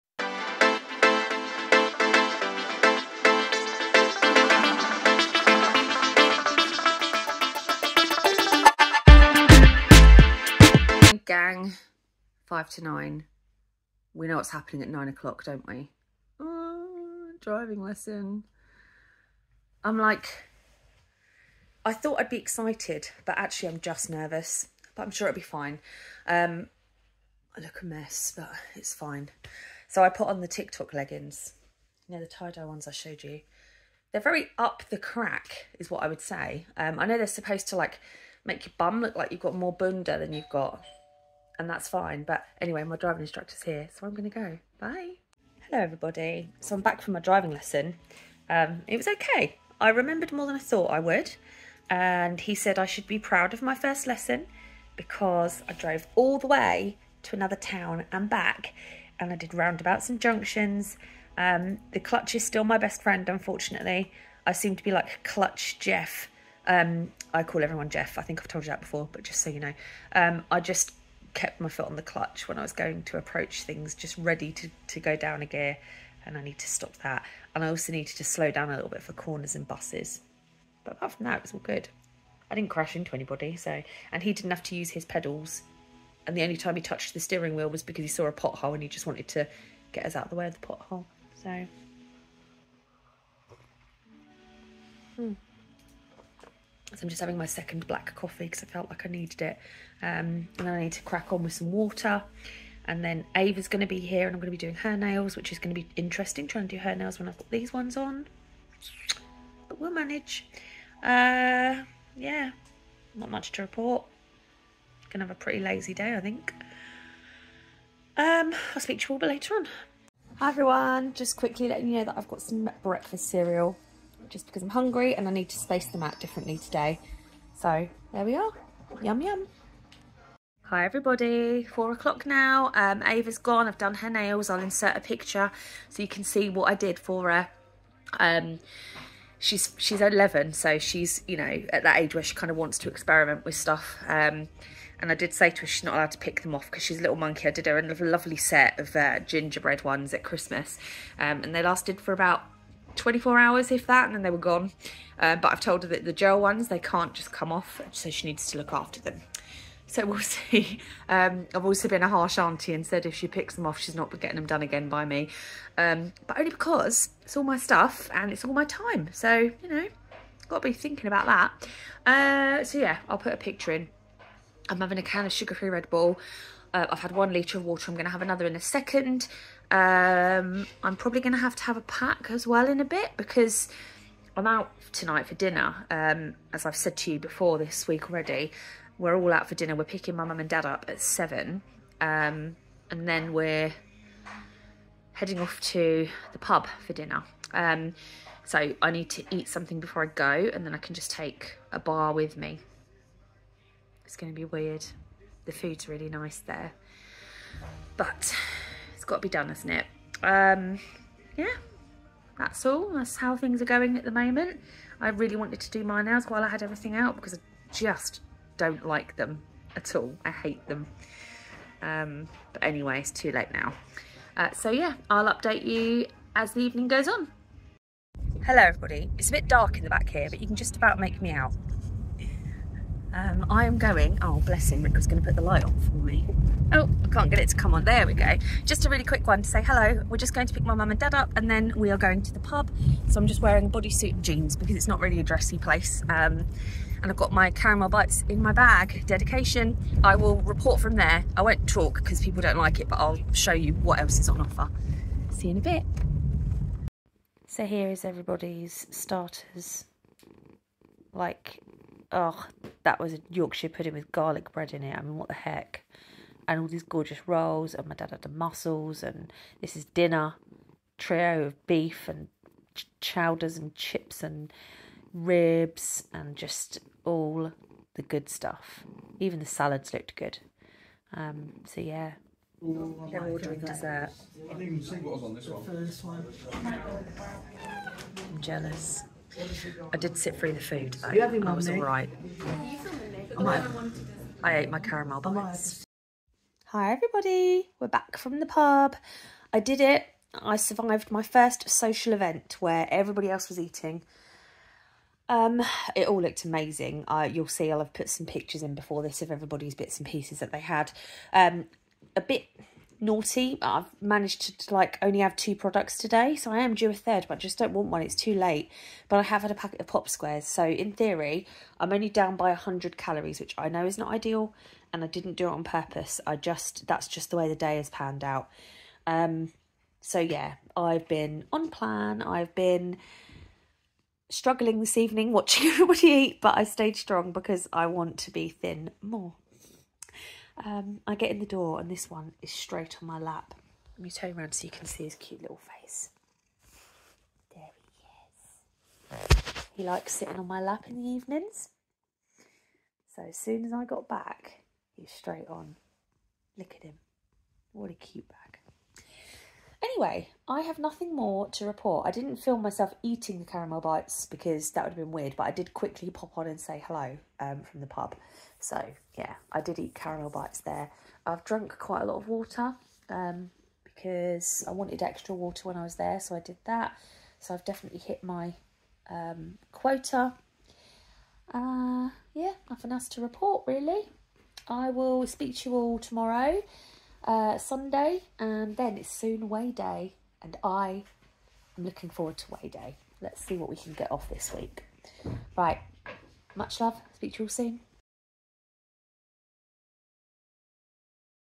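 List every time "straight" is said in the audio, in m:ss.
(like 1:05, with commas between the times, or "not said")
5:42, 5:55.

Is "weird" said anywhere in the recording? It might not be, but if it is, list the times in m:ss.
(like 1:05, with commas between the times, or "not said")
3:24, 6:05.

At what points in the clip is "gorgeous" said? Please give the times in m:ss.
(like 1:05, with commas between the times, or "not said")
4:26.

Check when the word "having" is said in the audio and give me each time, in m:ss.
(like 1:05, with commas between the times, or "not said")
1:37, 2:54, 4:51.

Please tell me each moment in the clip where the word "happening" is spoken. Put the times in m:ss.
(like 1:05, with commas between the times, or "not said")
0:14.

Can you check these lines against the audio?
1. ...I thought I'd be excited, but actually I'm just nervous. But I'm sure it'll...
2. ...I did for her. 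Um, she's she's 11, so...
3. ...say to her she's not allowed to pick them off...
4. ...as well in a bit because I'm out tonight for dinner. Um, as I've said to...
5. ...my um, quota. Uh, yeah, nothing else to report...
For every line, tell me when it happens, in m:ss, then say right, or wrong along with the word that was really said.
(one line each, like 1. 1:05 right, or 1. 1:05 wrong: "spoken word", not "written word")
1. 0:21 right
2. 2:16 right
3. 2:25 right
4. 3:02 right
5. 6:18 right.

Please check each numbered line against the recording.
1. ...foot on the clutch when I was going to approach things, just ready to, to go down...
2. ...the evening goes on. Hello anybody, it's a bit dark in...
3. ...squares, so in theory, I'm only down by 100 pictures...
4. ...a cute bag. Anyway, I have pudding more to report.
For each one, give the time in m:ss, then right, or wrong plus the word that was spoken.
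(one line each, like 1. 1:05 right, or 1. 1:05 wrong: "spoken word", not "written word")
1. 1:11 right
2. 3:46 wrong: "everybody", not "anybody"
3. 5:20 wrong: "calories", not "pictures"
4. 5:57 wrong: "nothing", not "pudding".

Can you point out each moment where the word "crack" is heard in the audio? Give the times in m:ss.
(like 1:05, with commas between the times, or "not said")
0:34, 1:41.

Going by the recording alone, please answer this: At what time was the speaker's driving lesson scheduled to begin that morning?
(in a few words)
9 o'clock.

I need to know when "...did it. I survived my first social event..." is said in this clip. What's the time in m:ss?
4:59.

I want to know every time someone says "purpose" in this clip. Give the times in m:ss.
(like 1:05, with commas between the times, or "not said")
5:25.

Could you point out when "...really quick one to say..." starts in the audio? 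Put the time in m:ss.
3:58.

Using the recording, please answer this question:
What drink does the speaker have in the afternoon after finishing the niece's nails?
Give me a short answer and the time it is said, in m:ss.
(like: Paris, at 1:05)
Sugar-free Red Bull, at 2:55.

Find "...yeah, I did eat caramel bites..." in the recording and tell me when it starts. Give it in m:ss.
6:09.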